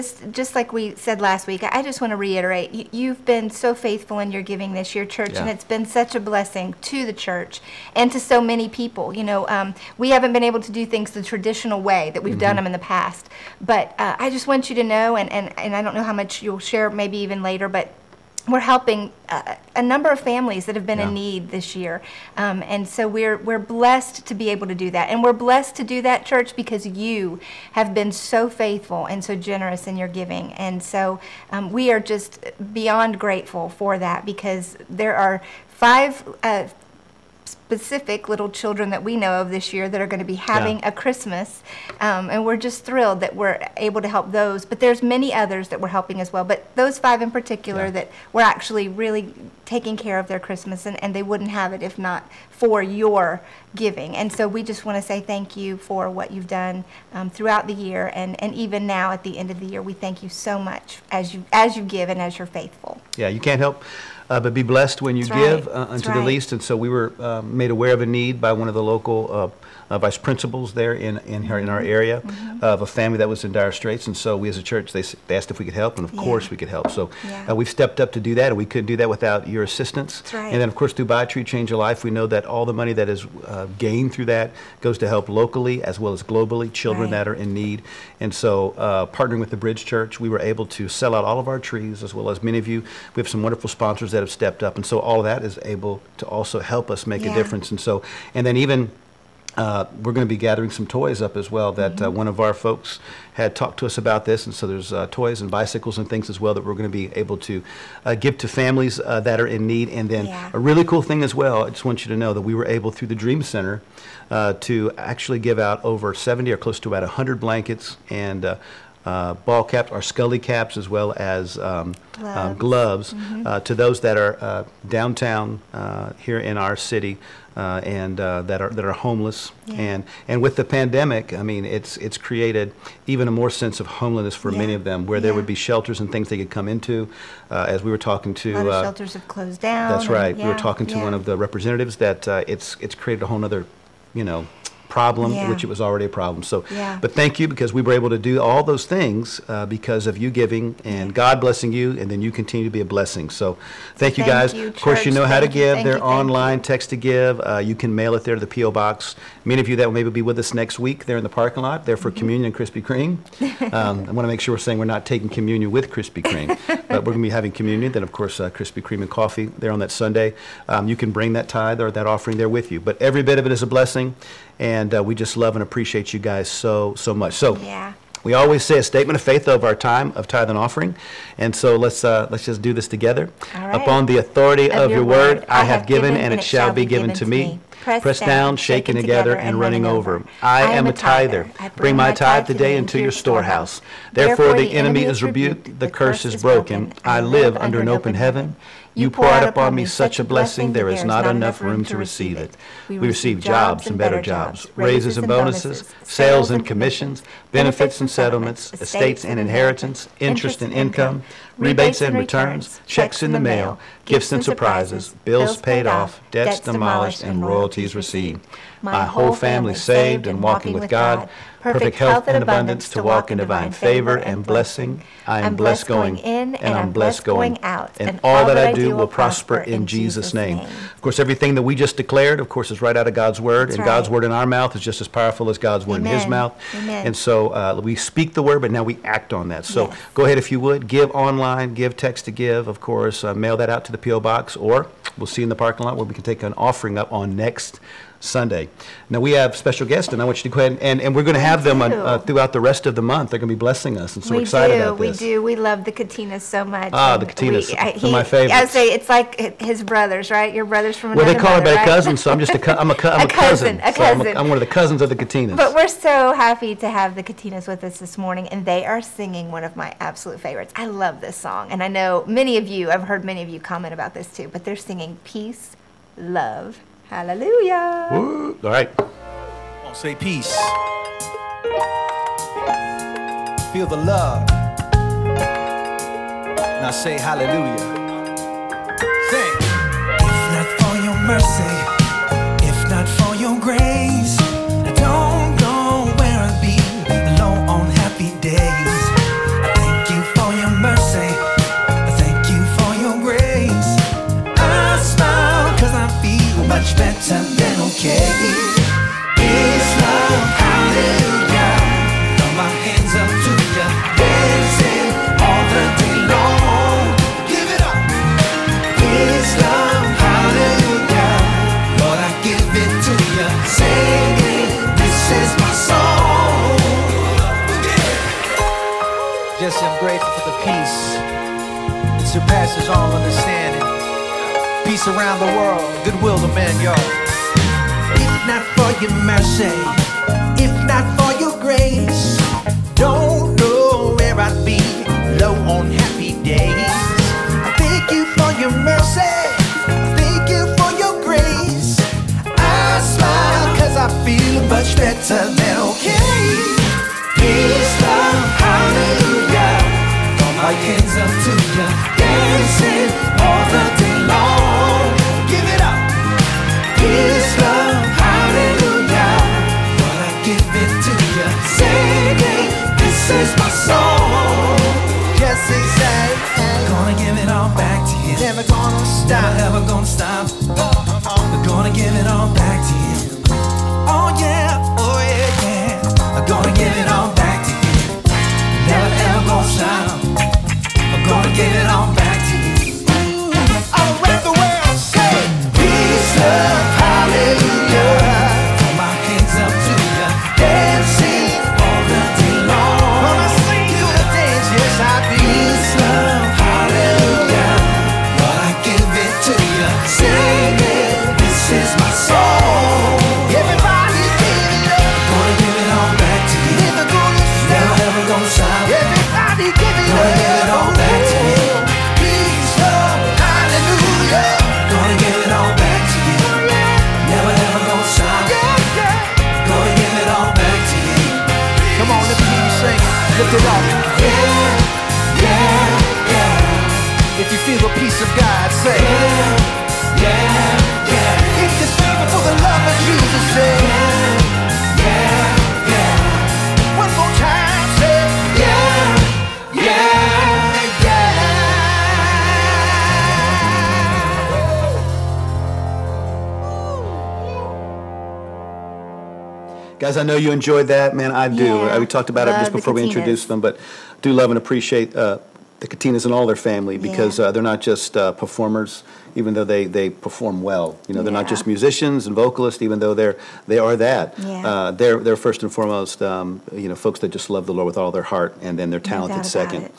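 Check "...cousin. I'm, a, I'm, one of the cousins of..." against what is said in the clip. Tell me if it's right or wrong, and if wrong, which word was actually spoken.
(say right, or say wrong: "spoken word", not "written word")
right.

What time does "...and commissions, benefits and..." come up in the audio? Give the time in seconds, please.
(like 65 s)
206 s.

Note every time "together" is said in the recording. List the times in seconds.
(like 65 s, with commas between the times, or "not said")
182 s, 188 s.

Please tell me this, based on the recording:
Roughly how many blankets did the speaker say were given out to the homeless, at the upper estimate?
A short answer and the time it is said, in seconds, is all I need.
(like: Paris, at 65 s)
100, at 117 s.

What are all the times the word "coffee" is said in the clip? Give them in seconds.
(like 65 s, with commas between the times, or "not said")
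169 s.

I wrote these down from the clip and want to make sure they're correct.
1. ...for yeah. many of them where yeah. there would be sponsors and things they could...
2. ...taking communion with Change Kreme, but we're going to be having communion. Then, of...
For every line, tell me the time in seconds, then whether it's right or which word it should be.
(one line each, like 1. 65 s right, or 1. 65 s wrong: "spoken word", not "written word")
1. 134 s wrong: "shelters", not "sponsors"
2. 165 s wrong: "Krispy", not "Change".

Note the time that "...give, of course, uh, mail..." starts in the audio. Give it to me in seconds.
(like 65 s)
242 s.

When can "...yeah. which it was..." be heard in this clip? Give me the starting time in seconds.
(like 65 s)
145 s.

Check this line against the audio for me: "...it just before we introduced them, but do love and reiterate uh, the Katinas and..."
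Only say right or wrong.
wrong.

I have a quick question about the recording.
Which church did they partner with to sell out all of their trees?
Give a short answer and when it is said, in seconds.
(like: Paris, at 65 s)
the Bridge Church, at 89 s.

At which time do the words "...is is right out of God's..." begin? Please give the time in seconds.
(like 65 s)
232 s.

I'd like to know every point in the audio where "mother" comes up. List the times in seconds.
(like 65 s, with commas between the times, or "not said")
261 s.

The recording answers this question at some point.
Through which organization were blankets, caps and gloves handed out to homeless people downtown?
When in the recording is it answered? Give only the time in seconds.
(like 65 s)
113 s.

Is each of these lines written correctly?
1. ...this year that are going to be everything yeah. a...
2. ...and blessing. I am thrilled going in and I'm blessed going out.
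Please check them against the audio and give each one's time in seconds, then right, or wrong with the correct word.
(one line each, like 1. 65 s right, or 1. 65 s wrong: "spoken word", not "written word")
1. 39 s wrong: "having", not "everything"
2. 224 s wrong: "blessed", not "thrilled".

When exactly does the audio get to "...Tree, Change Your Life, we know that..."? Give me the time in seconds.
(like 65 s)
81 s.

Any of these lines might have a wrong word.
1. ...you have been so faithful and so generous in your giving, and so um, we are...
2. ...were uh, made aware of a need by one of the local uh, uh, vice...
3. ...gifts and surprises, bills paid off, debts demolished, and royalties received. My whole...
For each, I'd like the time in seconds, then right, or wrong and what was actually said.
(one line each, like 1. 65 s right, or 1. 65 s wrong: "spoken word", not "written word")
1. 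26 s right
2. 66 s right
3. 214 s right.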